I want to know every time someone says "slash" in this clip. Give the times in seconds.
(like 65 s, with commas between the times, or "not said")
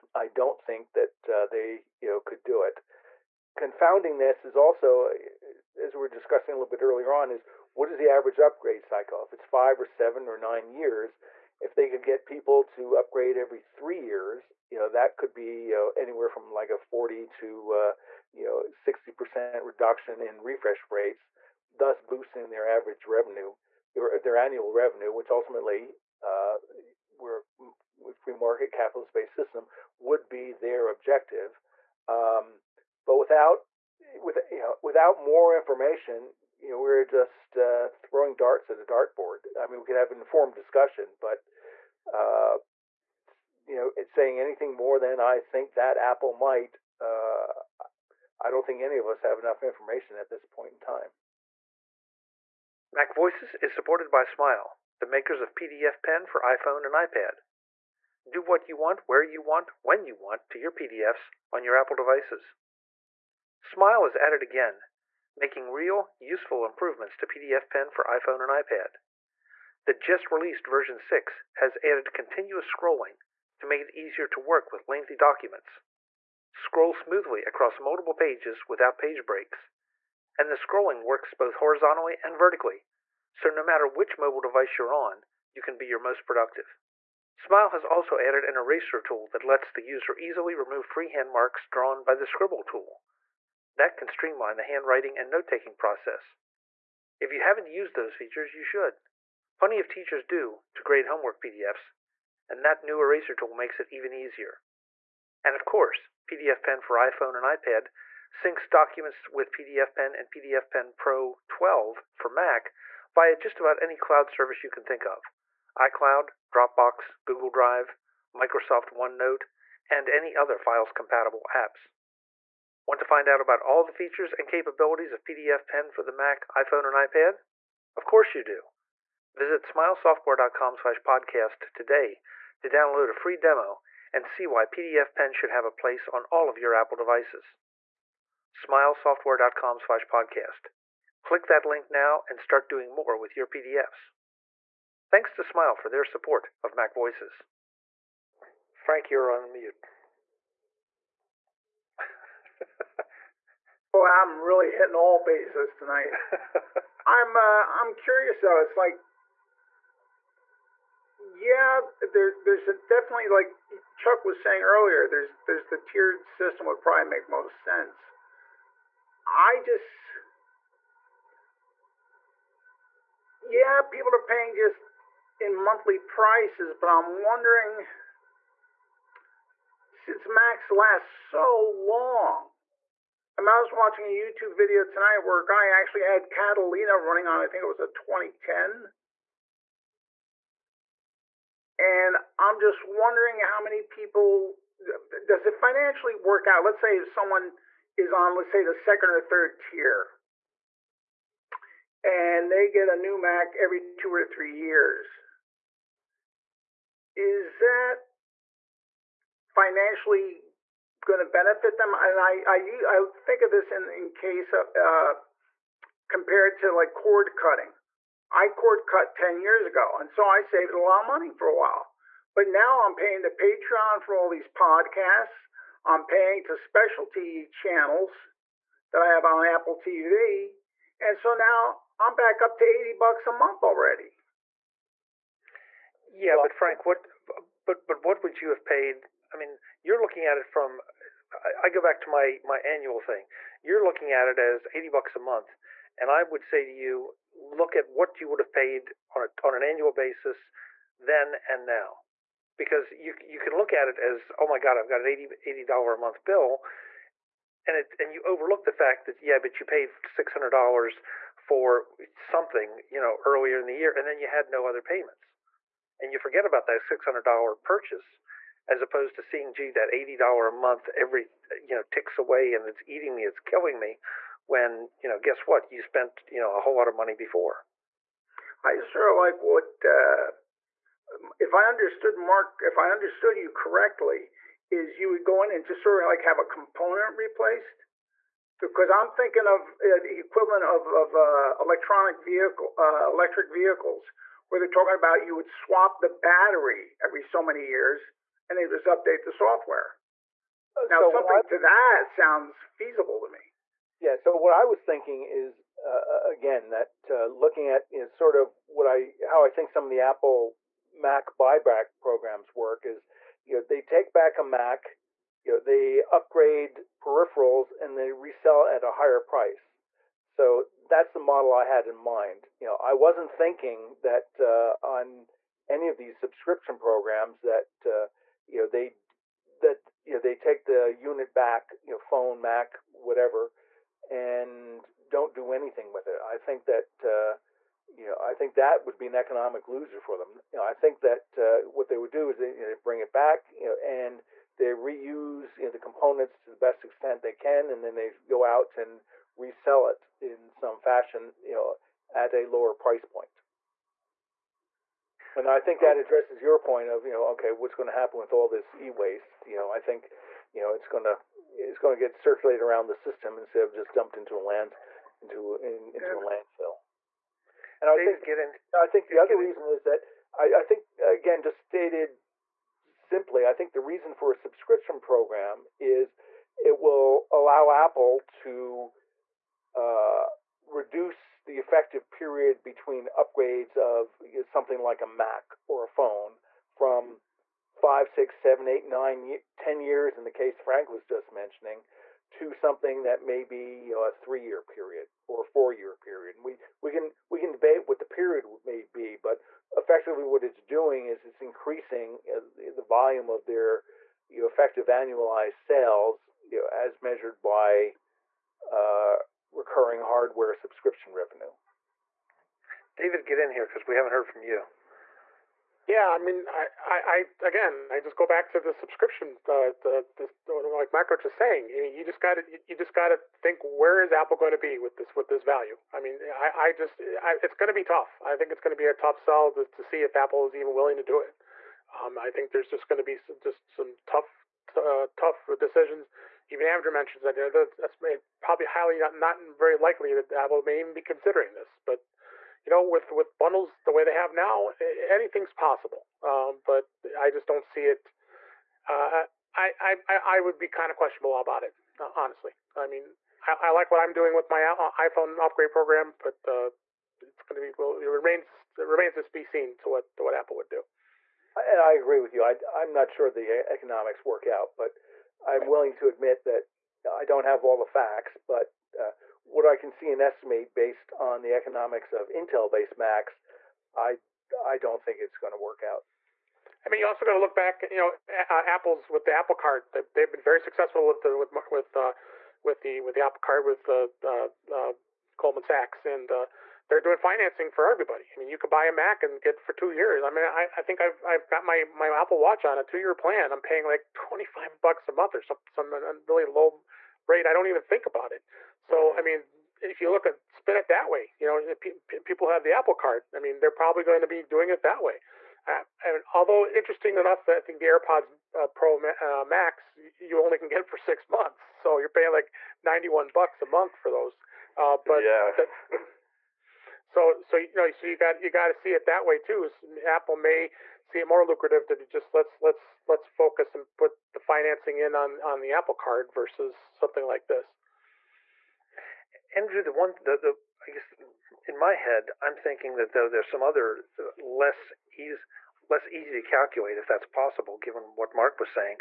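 139 s.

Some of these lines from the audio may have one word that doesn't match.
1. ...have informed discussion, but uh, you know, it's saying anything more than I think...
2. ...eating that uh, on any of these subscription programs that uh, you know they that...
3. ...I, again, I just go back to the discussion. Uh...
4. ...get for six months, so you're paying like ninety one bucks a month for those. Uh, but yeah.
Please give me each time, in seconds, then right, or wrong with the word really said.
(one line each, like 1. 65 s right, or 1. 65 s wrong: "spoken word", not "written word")
1. 39 s right
2. 323 s wrong: "thinking", not "eating"
3. 417 s wrong: "subscription", not "discussion"
4. 510 s right.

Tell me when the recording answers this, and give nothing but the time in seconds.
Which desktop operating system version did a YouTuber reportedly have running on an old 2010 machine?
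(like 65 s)
186 s.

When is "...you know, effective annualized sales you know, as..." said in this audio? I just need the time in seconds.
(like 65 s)
404 s.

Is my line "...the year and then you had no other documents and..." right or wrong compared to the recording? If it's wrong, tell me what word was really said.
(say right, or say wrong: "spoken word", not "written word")
wrong: "payments", not "documents".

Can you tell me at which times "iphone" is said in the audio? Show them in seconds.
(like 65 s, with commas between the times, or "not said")
56 s, 68 s, 106 s, 126 s, 454 s.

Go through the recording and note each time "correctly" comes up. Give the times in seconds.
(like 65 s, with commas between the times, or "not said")
283 s.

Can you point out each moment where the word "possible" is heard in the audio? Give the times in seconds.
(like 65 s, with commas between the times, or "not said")
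445 s, 537 s.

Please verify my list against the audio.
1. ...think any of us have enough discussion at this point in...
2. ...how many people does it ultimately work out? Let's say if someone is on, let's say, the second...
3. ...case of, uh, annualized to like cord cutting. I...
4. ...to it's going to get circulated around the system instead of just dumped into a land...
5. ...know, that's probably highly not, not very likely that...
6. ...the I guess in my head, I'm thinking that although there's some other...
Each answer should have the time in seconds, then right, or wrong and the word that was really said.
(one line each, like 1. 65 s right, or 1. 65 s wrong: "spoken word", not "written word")
1. 48 s wrong: "information", not "discussion"
2. 193 s wrong: "financially", not "ultimately"
3. 214 s wrong: "compared", not "annualized"
4. 361 s right
5. 437 s right
6. 530 s wrong: "though", not "although".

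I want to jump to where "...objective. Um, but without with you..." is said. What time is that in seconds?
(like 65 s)
30 s.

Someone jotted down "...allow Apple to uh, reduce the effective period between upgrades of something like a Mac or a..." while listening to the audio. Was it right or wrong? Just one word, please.
right.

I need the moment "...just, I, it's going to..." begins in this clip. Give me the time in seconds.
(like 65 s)
426 s.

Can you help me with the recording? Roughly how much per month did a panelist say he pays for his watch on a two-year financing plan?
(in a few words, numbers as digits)
25 bucks.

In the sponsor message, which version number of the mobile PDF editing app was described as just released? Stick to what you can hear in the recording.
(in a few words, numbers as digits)
6.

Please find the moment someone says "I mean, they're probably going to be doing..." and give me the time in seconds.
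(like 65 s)
503 s.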